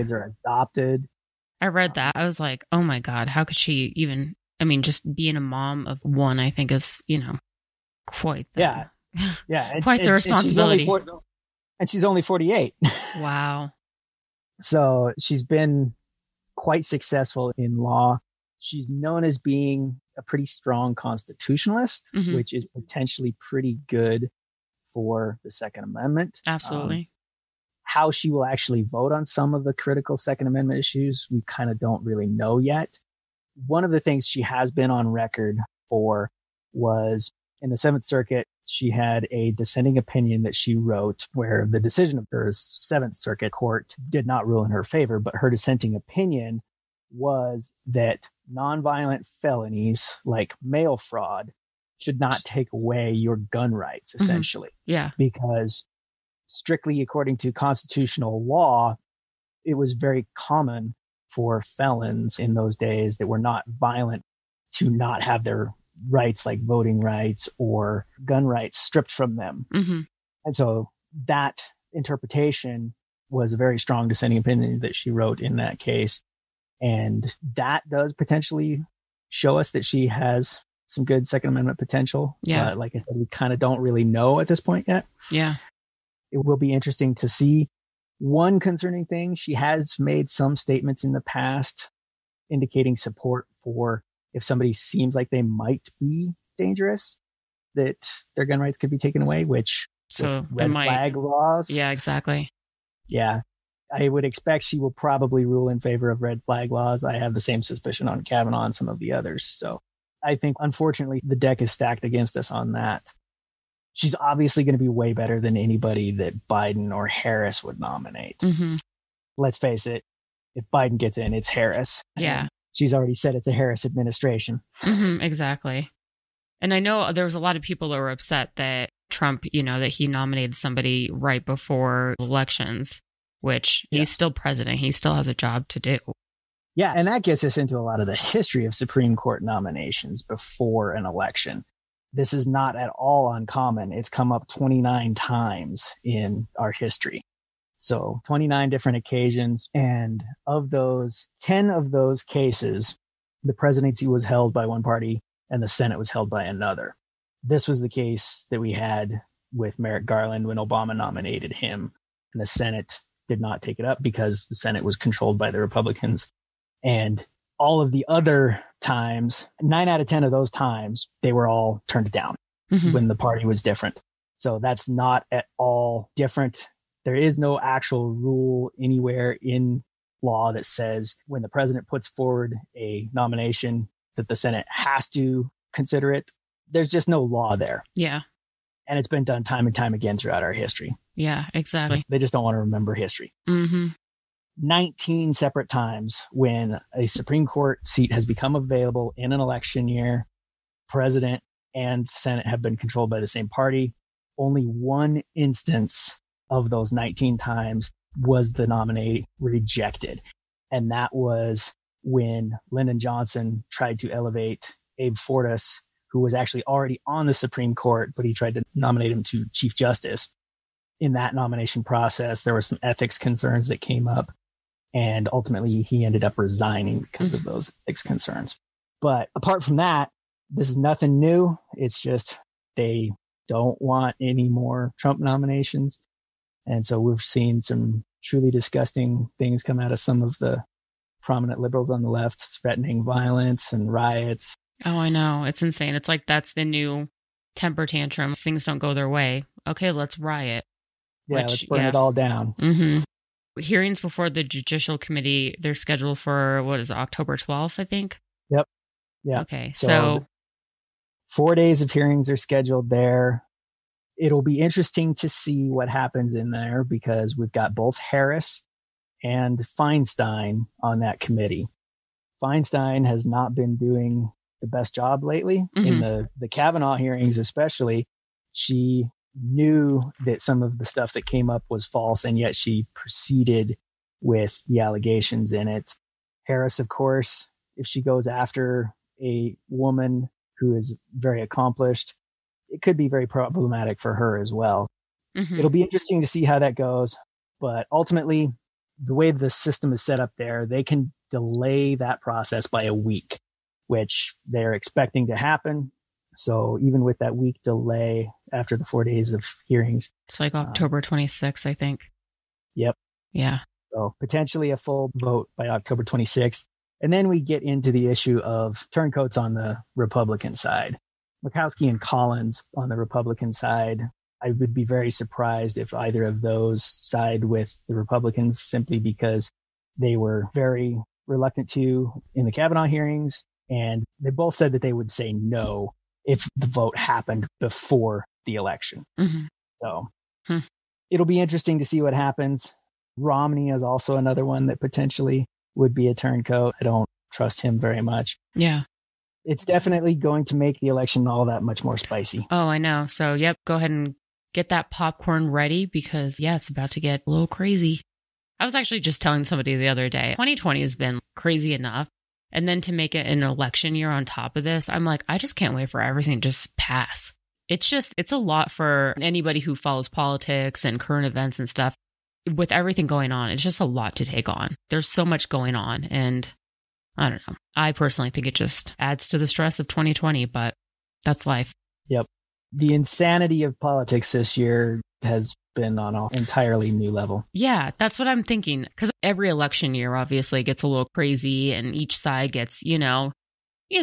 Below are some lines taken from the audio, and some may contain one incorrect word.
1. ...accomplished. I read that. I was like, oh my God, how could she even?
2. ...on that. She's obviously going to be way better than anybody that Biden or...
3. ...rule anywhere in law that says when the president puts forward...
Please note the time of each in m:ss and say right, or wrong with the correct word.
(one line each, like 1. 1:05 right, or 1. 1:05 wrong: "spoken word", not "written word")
1. 0:00 wrong: "adopted", not "accomplished"
2. 1:52 right
3. 2:58 right.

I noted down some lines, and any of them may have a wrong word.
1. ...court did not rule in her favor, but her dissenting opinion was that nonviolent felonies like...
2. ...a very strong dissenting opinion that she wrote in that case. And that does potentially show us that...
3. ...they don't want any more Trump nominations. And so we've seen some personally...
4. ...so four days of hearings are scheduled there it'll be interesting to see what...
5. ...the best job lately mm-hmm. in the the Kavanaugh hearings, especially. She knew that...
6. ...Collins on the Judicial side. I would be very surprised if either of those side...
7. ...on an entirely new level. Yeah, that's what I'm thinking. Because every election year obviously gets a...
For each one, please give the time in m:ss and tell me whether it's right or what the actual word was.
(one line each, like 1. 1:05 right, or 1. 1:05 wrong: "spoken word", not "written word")
1. 0:43 right
2. 1:13 right
3. 3:52 wrong: "truly", not "personally"
4. 4:19 right
5. 4:34 right
6. 5:21 wrong: "Republican", not "Judicial"
7. 6:25 right.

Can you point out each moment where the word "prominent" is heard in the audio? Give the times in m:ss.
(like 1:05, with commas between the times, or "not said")
4:01.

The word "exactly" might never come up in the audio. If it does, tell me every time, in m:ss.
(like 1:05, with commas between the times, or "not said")
1:41, 2:05, 3:11.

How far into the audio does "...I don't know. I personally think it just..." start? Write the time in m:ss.
6:17.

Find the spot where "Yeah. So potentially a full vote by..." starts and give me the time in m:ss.
5:13.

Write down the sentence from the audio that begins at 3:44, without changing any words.
And ultimately, he ended up resigning because of mm.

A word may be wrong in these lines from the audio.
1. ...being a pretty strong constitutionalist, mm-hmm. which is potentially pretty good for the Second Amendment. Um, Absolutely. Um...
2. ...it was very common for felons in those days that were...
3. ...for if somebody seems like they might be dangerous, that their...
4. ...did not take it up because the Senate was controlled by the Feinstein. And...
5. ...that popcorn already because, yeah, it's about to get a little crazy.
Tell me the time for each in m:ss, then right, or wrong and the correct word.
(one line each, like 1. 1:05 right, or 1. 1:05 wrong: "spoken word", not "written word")
1. 0:19 right
2. 0:59 right
3. 1:33 right
4. 2:43 wrong: "Republicans", not "Feinstein"
5. 5:54 wrong: "ready", not "already".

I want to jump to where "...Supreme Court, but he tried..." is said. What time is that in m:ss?
3:37.